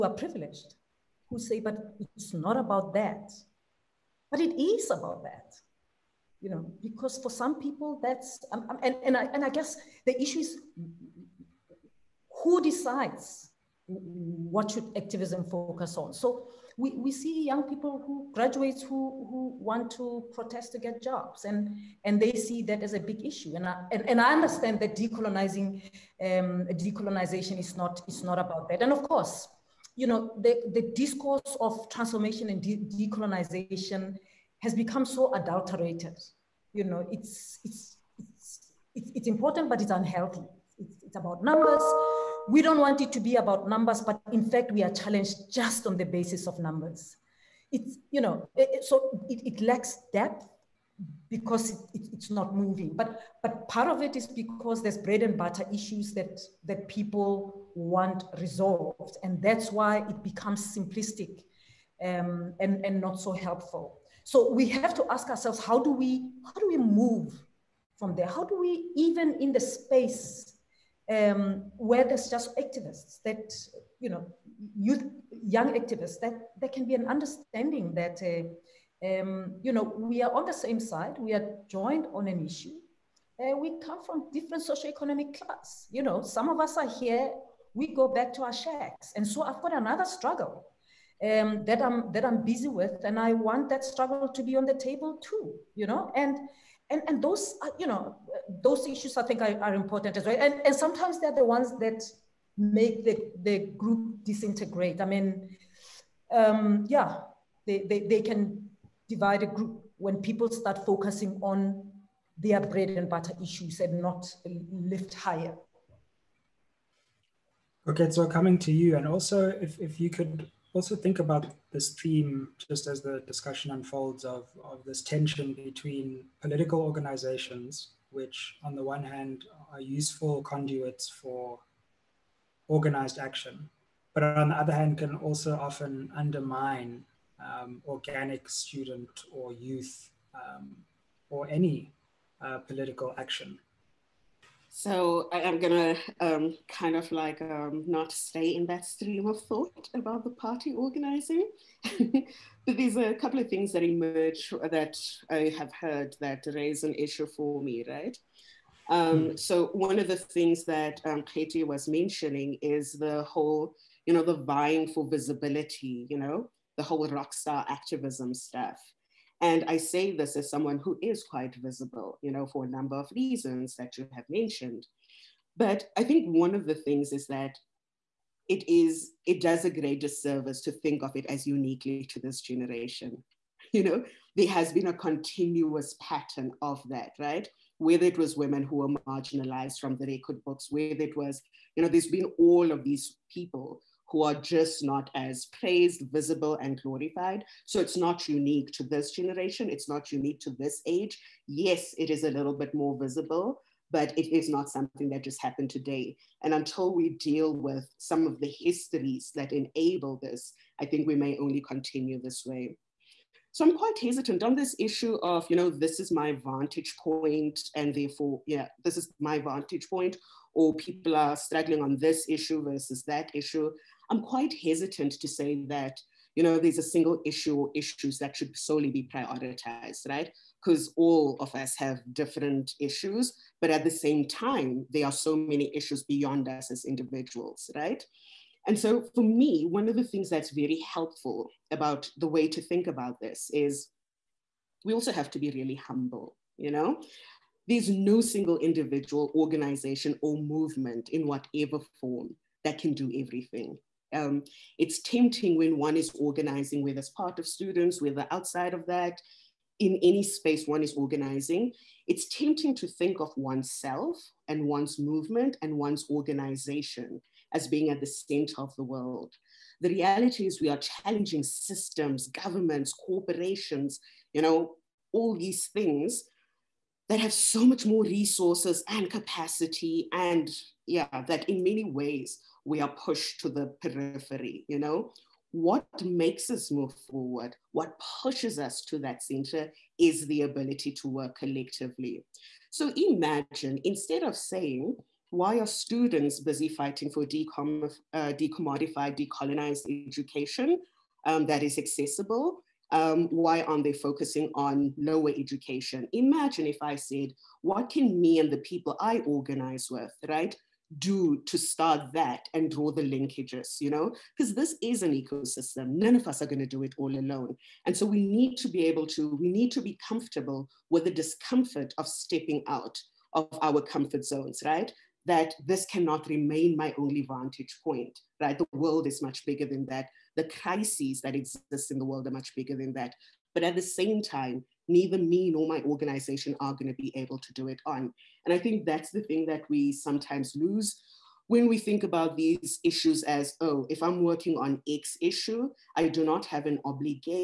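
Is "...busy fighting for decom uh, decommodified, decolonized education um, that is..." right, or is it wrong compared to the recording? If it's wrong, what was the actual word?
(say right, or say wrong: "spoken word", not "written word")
right.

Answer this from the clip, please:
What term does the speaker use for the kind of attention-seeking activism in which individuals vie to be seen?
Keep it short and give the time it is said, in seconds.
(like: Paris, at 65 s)
rock star activism, at 167 s.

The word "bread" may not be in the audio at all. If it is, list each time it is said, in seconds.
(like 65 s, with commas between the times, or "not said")
54 s, 112 s.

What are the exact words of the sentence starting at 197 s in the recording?
So it's not unique to this generation.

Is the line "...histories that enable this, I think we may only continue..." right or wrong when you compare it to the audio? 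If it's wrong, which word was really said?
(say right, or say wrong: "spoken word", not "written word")
right.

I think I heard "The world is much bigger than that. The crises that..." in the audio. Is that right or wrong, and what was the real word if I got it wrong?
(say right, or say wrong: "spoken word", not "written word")
right.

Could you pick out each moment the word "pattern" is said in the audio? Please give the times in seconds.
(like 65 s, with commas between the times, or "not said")
186 s.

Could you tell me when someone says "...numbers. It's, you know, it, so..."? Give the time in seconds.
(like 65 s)
46 s.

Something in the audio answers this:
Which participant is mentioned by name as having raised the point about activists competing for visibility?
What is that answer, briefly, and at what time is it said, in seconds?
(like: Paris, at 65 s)
Katie, at 161 s.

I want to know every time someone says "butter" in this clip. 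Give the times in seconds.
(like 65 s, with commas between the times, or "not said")
55 s, 113 s.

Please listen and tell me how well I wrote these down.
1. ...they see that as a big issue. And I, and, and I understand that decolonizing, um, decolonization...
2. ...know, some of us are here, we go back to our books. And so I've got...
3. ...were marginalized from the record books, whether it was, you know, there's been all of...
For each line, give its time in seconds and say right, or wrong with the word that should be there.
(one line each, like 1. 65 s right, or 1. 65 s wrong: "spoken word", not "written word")
1. 22 s right
2. 86 s wrong: "shacks", not "books"
3. 188 s right.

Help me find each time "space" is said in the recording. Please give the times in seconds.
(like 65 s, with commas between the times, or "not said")
69 s, 260 s.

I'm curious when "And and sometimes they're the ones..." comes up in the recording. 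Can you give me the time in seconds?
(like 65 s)
100 s.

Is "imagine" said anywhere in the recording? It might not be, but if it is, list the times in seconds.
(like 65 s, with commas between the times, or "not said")
292 s, 306 s.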